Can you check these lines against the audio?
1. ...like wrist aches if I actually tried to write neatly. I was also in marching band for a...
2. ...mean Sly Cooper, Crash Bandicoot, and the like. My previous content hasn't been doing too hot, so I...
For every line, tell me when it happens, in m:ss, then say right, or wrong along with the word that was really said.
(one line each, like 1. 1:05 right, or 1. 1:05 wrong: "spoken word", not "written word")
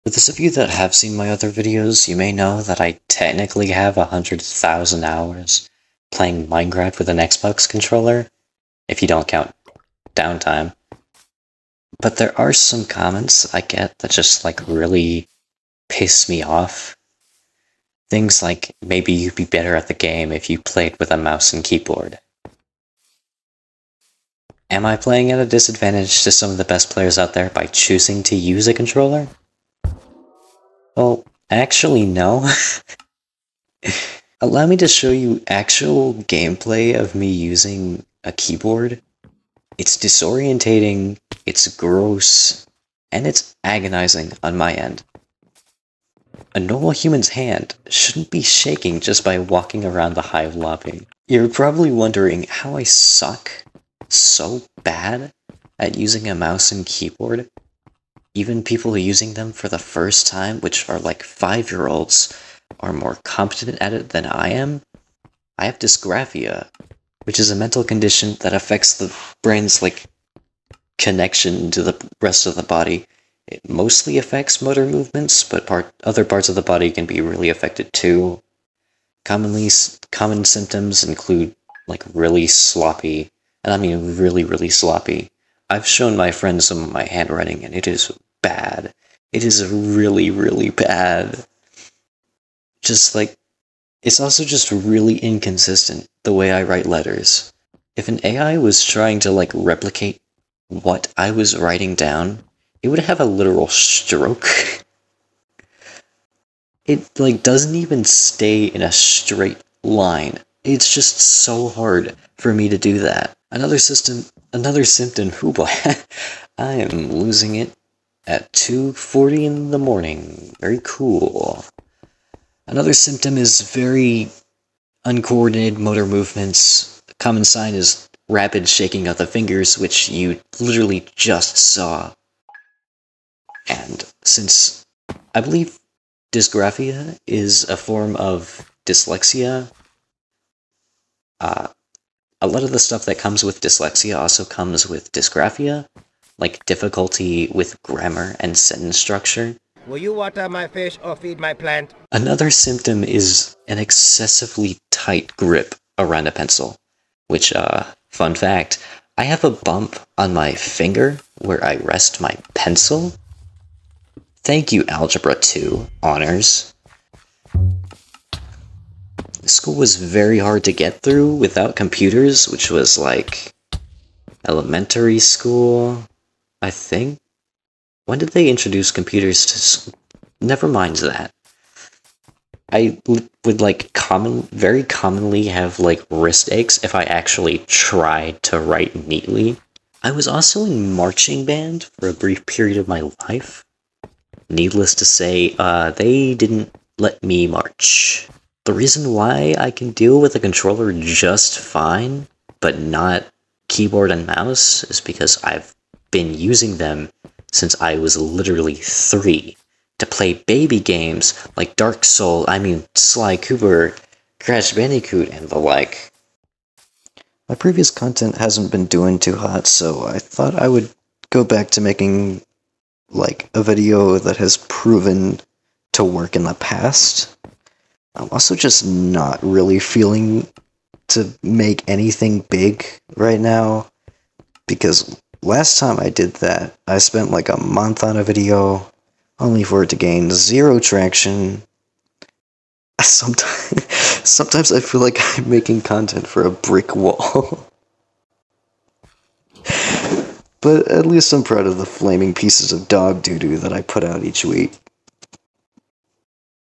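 1. 3:05 right
2. 3:32 right.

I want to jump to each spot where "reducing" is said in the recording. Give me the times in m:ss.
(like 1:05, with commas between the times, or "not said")
not said.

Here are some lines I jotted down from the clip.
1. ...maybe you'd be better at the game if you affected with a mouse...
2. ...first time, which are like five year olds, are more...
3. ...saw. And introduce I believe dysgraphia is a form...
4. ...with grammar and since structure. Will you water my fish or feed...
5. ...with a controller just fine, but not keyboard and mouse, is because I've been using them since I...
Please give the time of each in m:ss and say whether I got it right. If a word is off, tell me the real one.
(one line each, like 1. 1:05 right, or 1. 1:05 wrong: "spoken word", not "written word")
1. 0:18 wrong: "played", not "affected"
2. 0:59 right
3. 2:11 wrong: "since", not "introduce"
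4. 2:27 wrong: "sentence", not "since"
5. 3:20 right.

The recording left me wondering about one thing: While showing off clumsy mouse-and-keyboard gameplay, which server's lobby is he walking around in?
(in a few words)
The Hive.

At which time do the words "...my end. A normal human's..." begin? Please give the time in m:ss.
0:44.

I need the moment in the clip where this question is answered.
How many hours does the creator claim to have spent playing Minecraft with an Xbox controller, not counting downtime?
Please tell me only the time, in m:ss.
0:03.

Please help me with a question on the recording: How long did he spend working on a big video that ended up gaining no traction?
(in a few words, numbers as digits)
A month.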